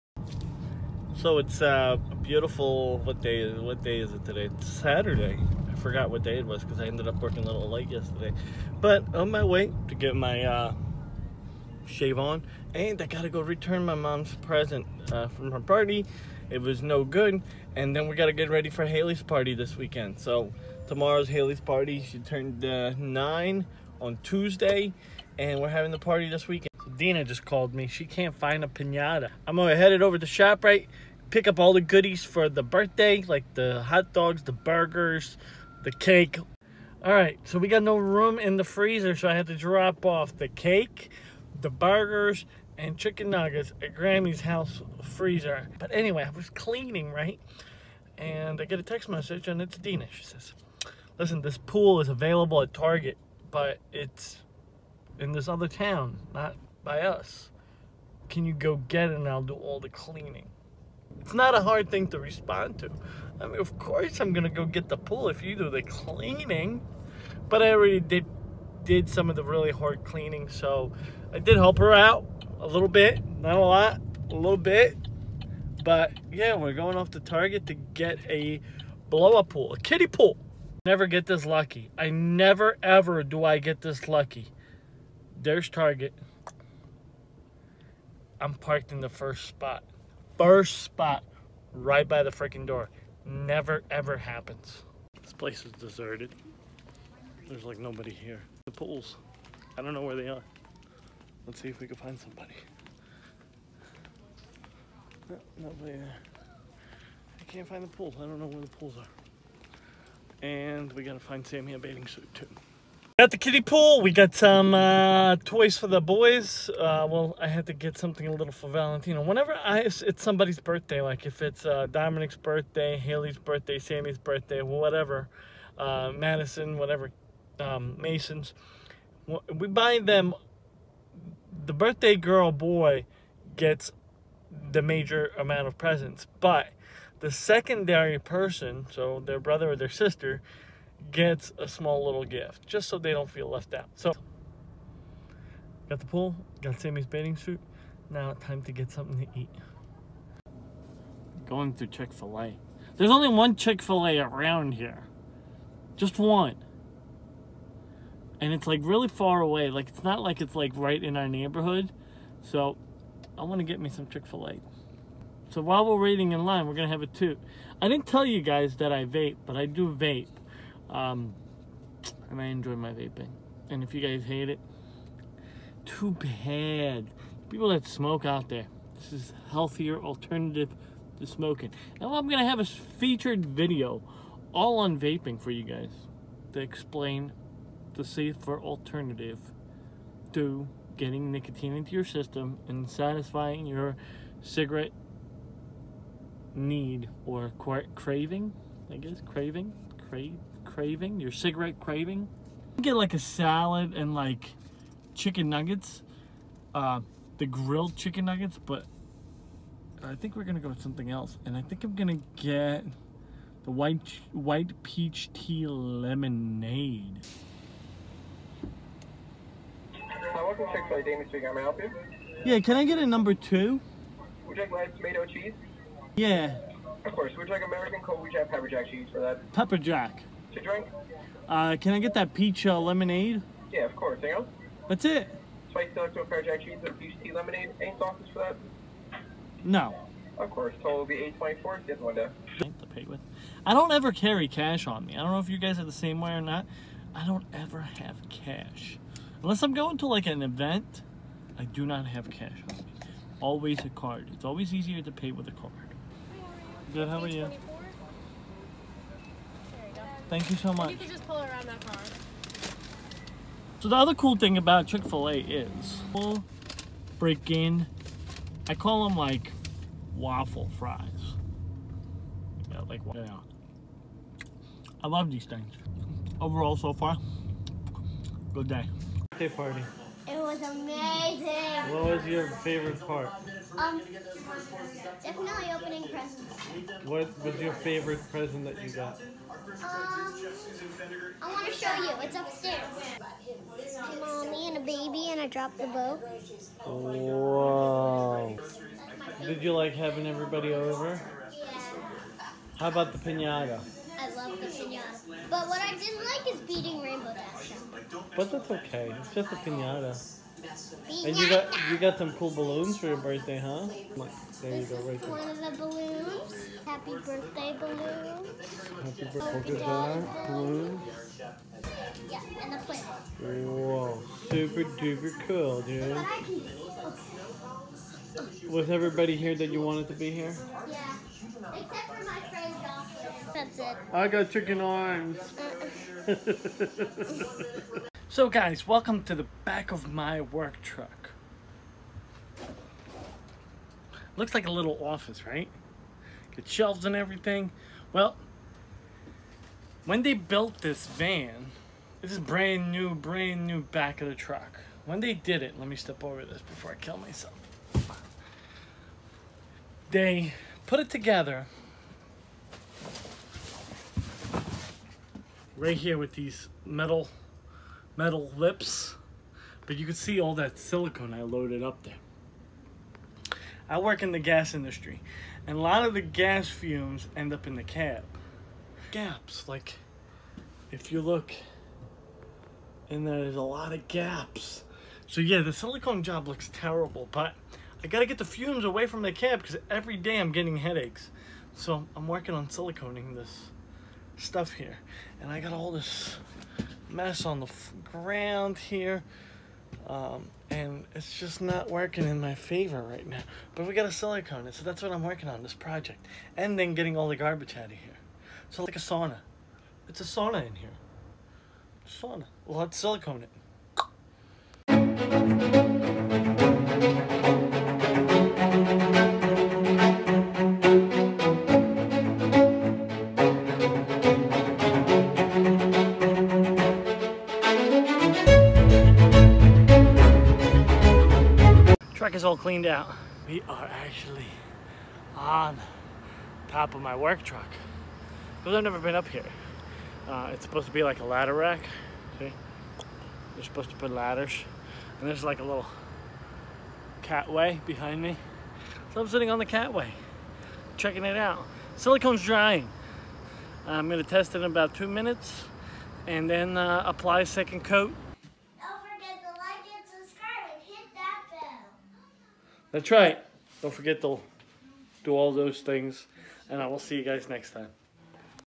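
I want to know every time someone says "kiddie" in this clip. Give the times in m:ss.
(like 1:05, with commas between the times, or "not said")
1:19, 1:53.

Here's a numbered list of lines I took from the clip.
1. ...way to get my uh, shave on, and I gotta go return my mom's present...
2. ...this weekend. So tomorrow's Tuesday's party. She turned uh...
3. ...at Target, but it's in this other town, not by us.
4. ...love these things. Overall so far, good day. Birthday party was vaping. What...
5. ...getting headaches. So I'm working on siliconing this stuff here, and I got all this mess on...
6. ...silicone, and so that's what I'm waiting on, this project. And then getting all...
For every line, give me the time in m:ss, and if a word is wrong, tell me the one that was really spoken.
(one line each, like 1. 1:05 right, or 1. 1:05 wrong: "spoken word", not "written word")
1. 0:09 right
2. 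0:19 wrong: "Haley", not "Tuesday"
3. 0:52 right
4. 4:35 wrong: "amazing", not "vaping"
5. 6:30 right
6. 6:44 wrong: "working", not "waiting".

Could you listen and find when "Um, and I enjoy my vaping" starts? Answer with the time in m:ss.
2:50.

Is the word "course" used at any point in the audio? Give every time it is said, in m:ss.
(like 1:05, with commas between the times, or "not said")
1:03, 3:47, 3:53, 4:00.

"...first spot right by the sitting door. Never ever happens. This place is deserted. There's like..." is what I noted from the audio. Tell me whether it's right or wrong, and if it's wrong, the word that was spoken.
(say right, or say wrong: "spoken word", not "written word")
wrong: "freaking", not "sitting".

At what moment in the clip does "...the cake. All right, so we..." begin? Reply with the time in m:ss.
0:35.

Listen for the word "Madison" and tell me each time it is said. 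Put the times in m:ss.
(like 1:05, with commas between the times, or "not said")
2:06.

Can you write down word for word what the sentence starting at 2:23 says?
So, got the pool, got Sammy's bathing suit.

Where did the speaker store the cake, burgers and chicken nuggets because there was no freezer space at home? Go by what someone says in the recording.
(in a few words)
Grammy's house.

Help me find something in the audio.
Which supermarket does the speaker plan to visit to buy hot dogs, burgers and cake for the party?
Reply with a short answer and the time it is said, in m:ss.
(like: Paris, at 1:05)
ShopRite, at 0:30.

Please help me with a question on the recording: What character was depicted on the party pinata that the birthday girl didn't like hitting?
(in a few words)
Rainbow Dash.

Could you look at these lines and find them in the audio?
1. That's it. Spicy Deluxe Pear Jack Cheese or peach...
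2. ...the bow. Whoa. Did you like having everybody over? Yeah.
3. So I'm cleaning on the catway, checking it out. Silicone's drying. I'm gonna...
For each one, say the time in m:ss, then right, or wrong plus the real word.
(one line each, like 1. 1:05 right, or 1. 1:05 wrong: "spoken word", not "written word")
1. 3:54 right
2. 4:55 right
3. 7:29 wrong: "sitting", not "cleaning".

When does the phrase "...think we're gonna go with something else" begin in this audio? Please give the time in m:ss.
3:30.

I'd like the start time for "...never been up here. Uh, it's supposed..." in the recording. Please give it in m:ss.
7:18.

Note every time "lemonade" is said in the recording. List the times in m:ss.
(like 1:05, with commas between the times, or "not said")
3:35, 3:52, 3:57.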